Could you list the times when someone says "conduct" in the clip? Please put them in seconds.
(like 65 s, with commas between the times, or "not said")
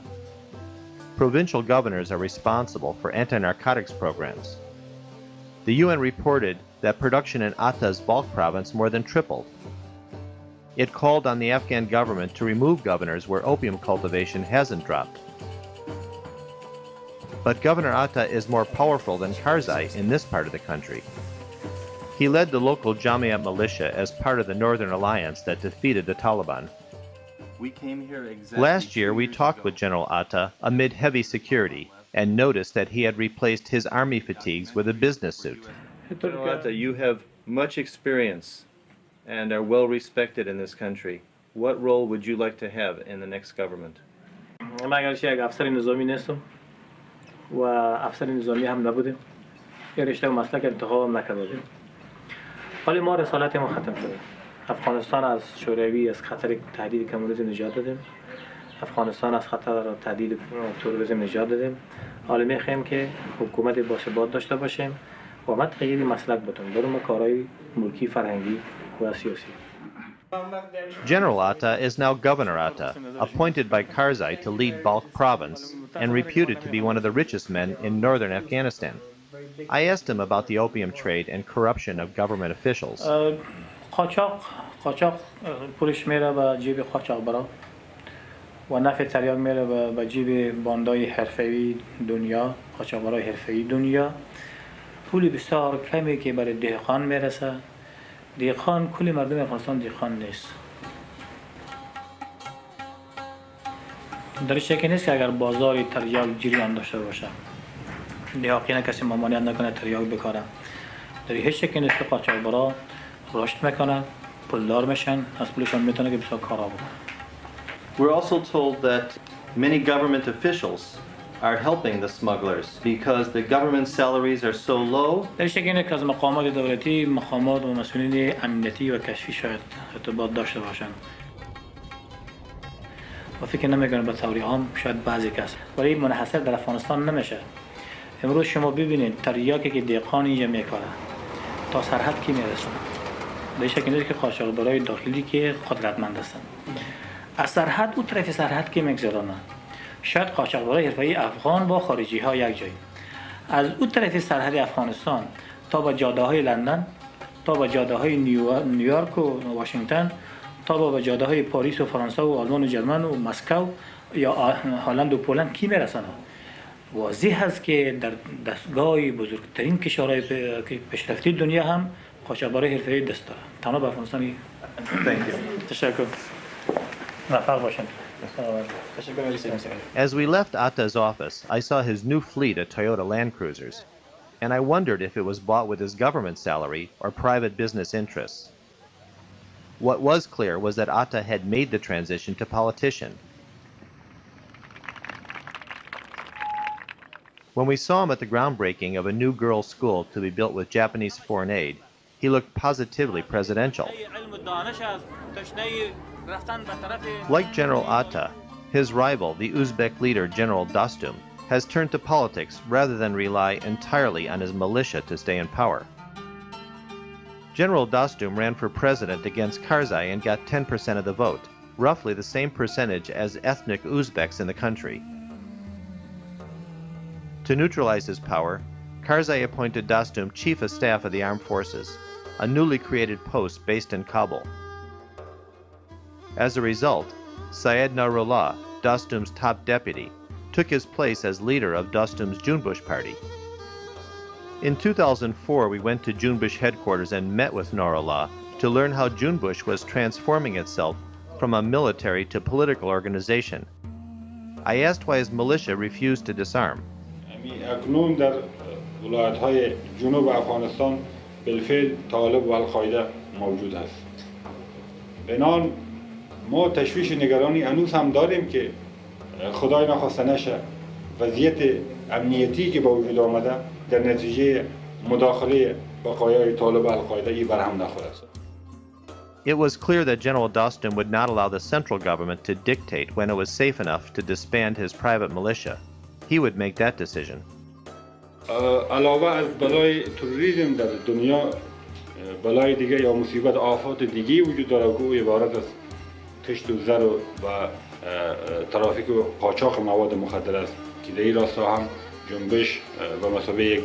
not said.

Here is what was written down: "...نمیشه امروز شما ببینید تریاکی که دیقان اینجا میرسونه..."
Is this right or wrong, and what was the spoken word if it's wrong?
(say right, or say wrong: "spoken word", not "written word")
wrong: "میکنه", not "میرسونه".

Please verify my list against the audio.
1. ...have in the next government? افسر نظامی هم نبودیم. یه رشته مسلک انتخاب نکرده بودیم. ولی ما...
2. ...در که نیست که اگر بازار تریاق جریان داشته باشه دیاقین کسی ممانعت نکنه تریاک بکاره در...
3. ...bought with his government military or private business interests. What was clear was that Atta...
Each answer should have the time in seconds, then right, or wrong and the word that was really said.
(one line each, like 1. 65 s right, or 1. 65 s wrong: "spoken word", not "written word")
1. 42 s right
2. 104 s right
3. 185 s wrong: "salary", not "military".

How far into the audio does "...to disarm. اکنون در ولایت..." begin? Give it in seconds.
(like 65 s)
256 s.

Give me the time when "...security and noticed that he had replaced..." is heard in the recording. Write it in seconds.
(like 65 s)
31 s.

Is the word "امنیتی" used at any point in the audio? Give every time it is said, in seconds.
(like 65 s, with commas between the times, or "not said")
128 s, 272 s.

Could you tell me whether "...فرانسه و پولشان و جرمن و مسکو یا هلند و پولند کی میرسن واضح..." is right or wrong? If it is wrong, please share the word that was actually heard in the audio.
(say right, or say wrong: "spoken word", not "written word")
wrong: "آلمان", not "پولشان".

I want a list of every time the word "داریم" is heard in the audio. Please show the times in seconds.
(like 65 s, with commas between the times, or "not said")
268 s.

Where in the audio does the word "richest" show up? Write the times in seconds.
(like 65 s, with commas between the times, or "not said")
77 s.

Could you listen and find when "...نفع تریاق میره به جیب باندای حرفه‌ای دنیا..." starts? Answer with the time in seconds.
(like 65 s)
88 s.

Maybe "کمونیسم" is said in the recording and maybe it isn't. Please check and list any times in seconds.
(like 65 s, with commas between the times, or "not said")
57 s.